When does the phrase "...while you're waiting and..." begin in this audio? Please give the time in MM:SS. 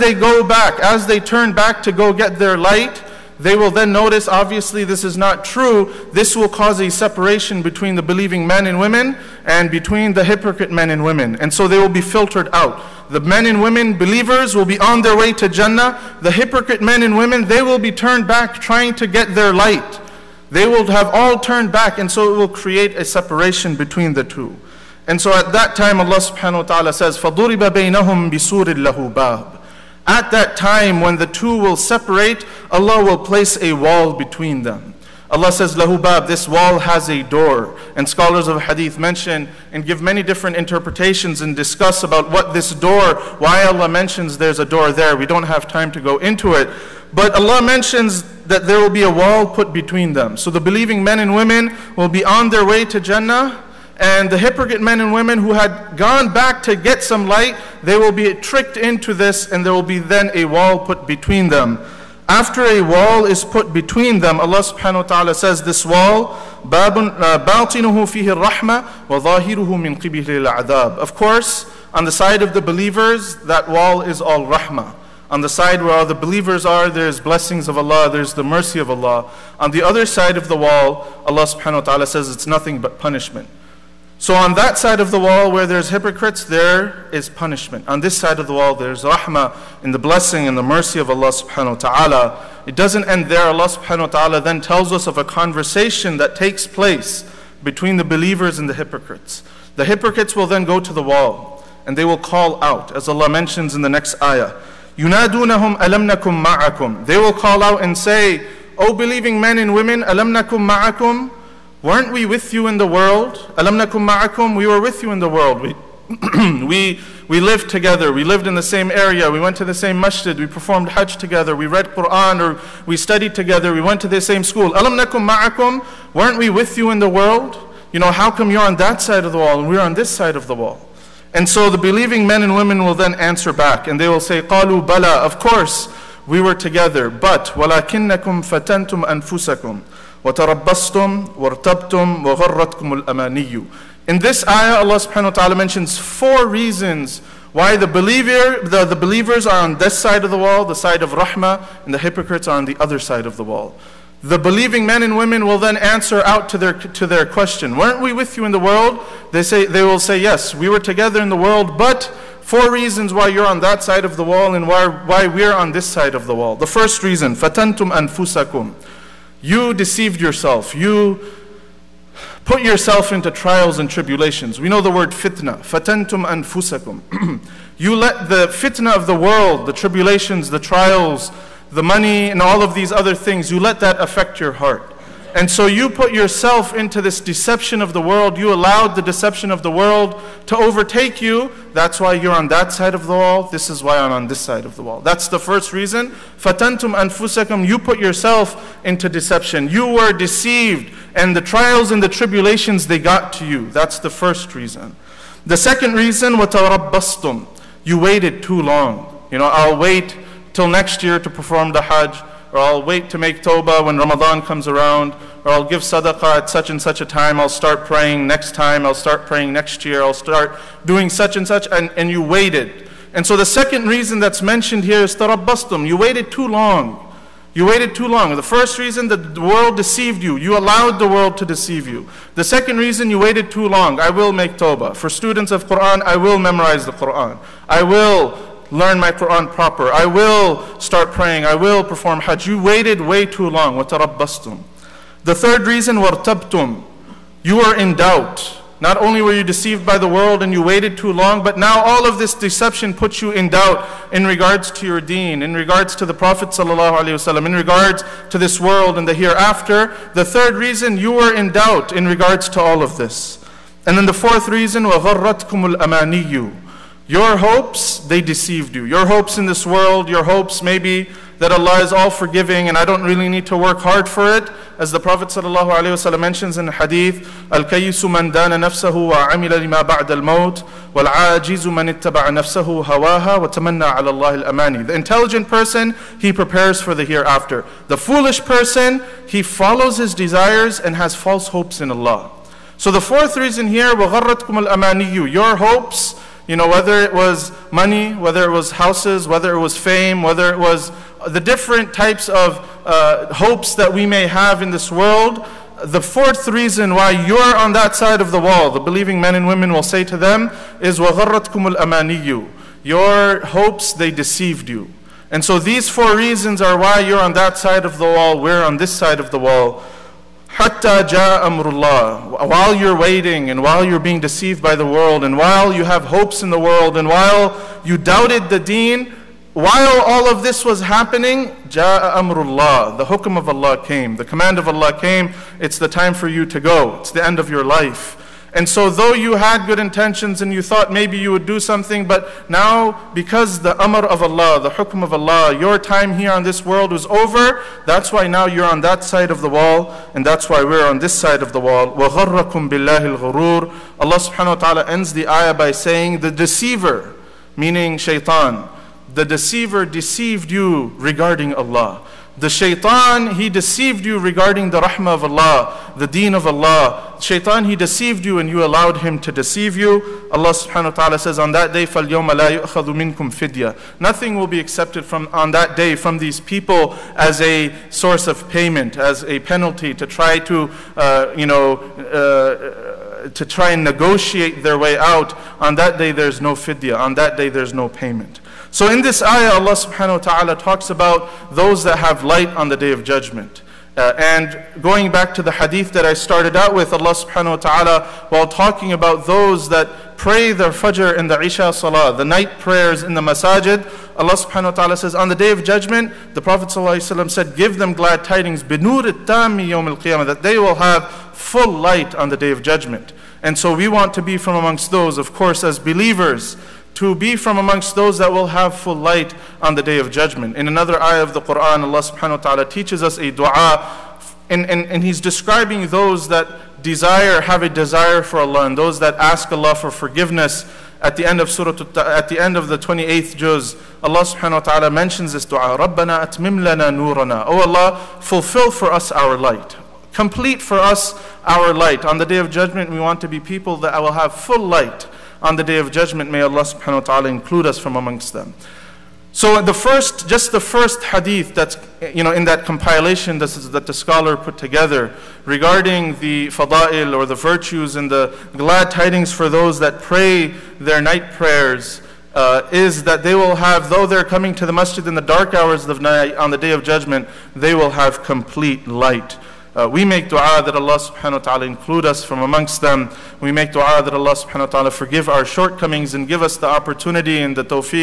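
05:22.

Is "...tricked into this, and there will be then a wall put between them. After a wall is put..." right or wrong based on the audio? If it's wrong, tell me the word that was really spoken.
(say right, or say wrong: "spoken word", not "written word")
right.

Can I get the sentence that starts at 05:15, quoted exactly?
And so these four reasons are why you're on that side of the wall, we're on this side of the wall.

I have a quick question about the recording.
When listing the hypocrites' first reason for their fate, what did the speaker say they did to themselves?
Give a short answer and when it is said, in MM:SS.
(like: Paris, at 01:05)
Deceived yourself, at 02:49.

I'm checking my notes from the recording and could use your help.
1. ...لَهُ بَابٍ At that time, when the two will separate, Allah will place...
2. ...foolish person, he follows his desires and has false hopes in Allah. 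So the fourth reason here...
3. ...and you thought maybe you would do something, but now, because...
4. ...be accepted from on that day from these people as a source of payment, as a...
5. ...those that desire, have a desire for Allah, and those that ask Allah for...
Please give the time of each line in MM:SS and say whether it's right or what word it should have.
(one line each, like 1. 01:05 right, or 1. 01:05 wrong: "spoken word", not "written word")
1. 00:28 right
2. 04:47 right
3. 05:40 right
4. 06:14 right
5. 07:05 right.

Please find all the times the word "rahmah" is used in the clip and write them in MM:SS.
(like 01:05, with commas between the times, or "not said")
01:14, 01:29, 02:31, 06:04.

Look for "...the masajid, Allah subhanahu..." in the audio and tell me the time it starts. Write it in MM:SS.
06:43.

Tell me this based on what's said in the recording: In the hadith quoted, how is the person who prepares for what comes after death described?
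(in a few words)
The intelligent person.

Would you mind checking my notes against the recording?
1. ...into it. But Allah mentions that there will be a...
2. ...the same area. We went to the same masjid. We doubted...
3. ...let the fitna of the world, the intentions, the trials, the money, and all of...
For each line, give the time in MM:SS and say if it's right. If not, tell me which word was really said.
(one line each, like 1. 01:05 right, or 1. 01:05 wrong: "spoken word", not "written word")
1. 00:46 right
2. 01:58 wrong: "performed", not "doubted"
3. 02:57 wrong: "tribulations", not "intentions".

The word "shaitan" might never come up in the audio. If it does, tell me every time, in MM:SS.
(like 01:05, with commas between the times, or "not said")
05:57, 06:02, 06:07.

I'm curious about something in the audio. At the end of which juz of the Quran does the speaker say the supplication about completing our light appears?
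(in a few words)
28th juz.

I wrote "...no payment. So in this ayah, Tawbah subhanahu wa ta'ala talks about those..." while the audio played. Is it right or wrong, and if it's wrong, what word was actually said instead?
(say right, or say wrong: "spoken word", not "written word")
wrong: "Allah", not "Tawbah".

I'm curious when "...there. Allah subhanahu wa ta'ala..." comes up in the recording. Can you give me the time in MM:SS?
01:33.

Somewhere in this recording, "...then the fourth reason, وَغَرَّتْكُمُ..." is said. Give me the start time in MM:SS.
04:23.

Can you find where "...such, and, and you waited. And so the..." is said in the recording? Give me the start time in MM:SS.
03:41.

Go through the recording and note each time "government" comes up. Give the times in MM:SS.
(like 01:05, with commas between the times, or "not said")
not said.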